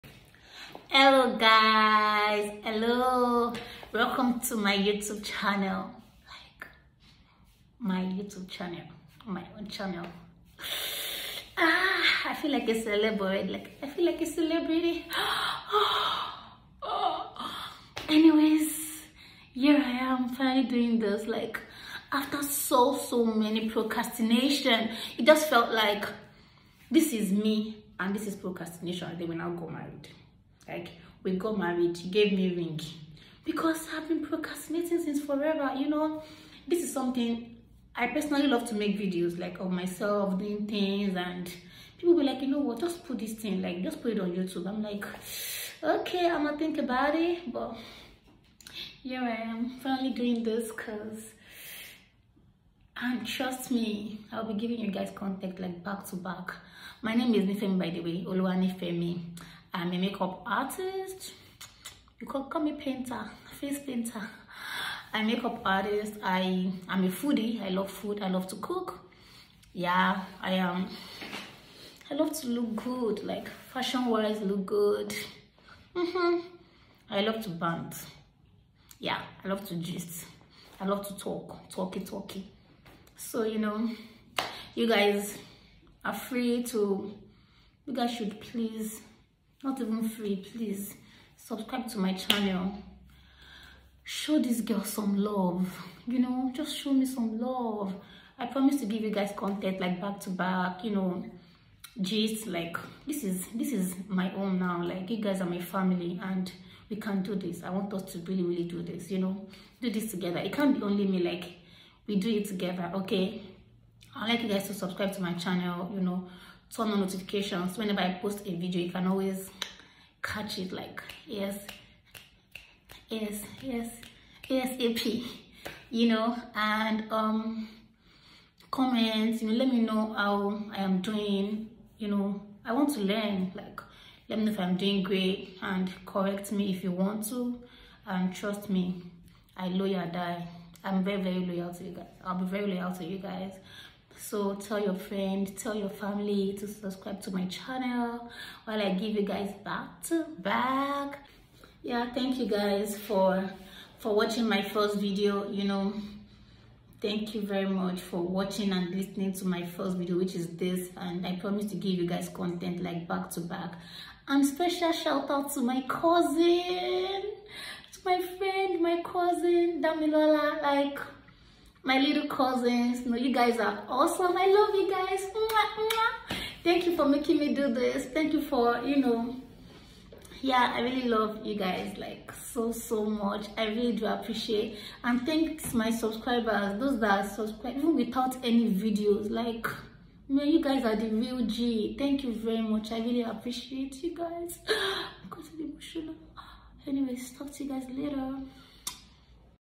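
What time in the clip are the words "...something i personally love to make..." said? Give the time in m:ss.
0:36.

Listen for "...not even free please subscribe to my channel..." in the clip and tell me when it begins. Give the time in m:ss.
1:29.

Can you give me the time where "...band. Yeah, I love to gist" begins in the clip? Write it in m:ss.
1:17.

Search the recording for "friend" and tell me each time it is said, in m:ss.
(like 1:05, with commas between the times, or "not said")
2:24, 2:48.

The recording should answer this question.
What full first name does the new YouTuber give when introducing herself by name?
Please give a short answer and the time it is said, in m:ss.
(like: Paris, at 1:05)
Oluwanifemi, at 0:58.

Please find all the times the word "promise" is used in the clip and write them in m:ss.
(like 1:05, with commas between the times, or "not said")
1:38, 2:41.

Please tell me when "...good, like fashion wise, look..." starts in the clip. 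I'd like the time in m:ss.
1:12.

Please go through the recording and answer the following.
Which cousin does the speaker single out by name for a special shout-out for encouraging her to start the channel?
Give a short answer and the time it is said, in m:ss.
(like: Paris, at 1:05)
Damilola, at 2:49.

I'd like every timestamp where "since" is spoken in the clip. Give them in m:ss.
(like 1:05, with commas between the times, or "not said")
0:35.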